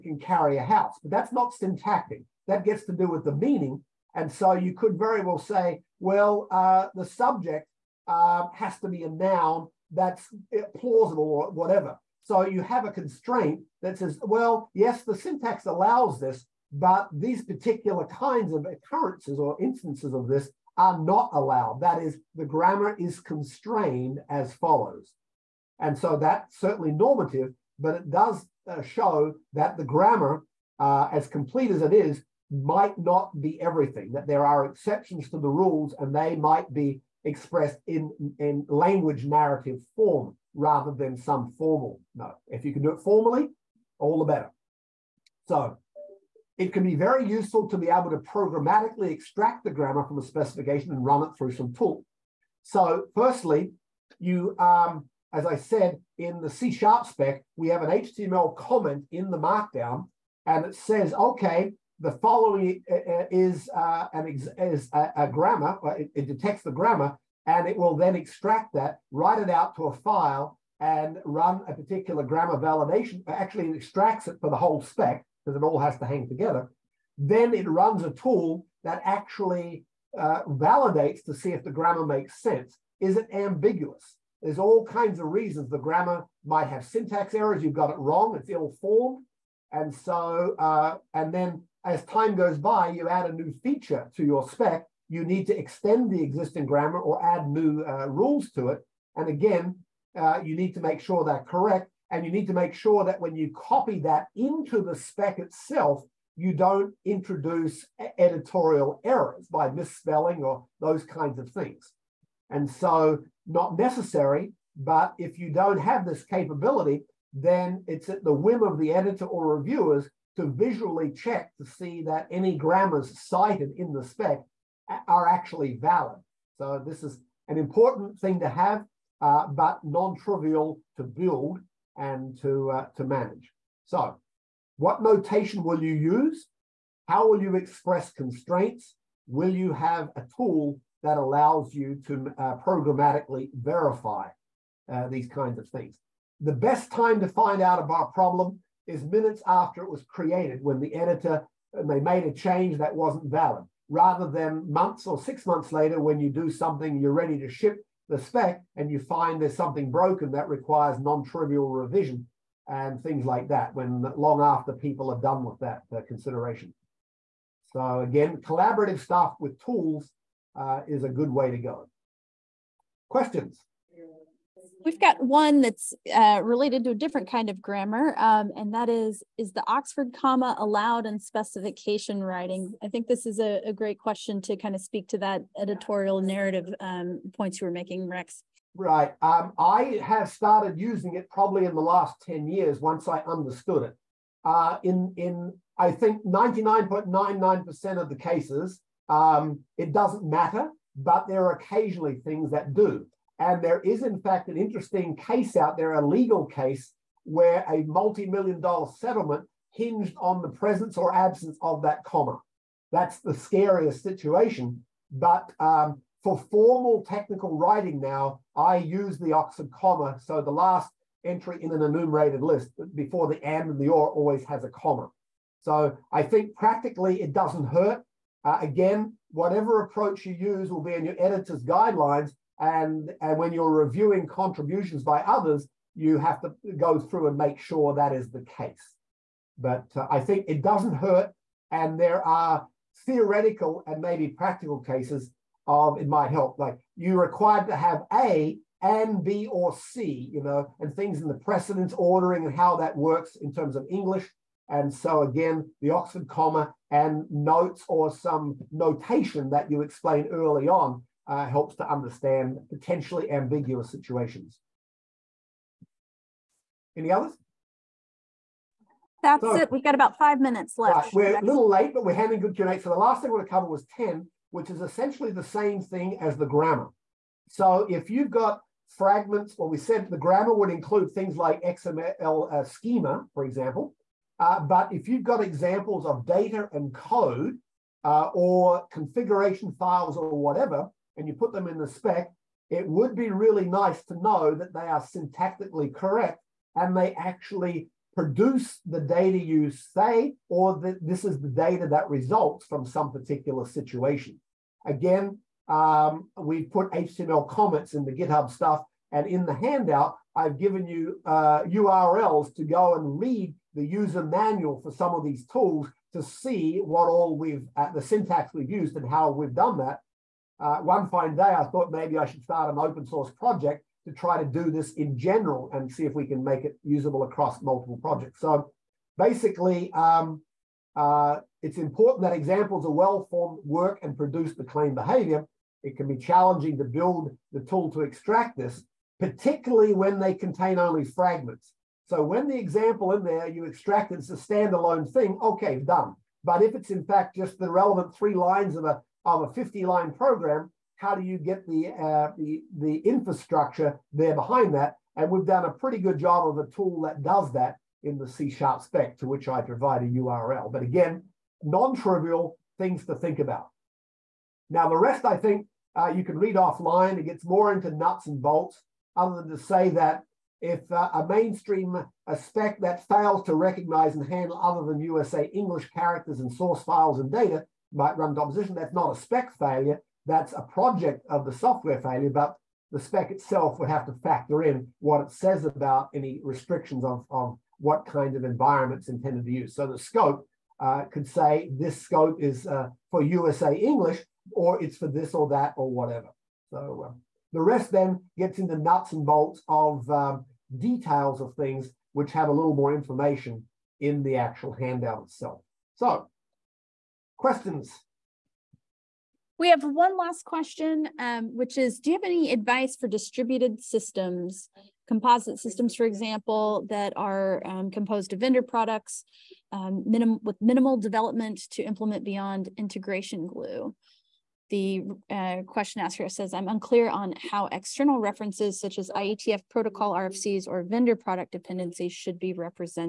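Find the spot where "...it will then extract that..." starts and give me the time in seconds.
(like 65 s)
67 s.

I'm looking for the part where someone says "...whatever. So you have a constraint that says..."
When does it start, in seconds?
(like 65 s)
11 s.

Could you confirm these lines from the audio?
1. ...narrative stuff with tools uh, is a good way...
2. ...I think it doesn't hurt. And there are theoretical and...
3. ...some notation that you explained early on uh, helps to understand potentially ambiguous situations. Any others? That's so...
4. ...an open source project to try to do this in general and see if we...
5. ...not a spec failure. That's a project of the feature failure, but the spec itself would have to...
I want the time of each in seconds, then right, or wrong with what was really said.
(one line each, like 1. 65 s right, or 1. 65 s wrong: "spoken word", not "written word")
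1. 168 s wrong: "collaborative", not "narrative"
2. 240 s right
3. 258 s right
4. 322 s right
5. 378 s wrong: "software", not "feature".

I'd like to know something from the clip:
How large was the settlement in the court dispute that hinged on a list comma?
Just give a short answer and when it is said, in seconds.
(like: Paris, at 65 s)
multi million dollar, at 207 s.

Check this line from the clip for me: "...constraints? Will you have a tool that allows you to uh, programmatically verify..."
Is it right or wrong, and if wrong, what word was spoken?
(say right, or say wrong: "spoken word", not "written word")
right.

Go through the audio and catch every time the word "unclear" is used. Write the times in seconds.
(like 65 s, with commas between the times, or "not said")
426 s.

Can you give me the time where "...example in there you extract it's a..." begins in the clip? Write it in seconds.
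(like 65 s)
342 s.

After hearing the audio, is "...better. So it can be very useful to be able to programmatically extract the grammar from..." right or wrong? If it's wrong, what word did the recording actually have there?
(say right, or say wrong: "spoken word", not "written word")
right.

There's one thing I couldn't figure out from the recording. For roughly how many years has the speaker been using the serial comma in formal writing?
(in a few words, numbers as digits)
10.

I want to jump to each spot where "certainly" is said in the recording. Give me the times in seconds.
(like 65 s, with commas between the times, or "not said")
26 s.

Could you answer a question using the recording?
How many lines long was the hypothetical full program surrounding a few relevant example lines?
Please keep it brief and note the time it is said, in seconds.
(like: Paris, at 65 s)
50 lines, at 349 s.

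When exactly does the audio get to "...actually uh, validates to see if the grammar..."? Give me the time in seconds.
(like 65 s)
79 s.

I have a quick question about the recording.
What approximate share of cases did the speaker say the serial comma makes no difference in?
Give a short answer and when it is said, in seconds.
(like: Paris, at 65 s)
99.99%, at 196 s.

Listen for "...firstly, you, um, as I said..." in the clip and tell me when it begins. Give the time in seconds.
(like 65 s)
53 s.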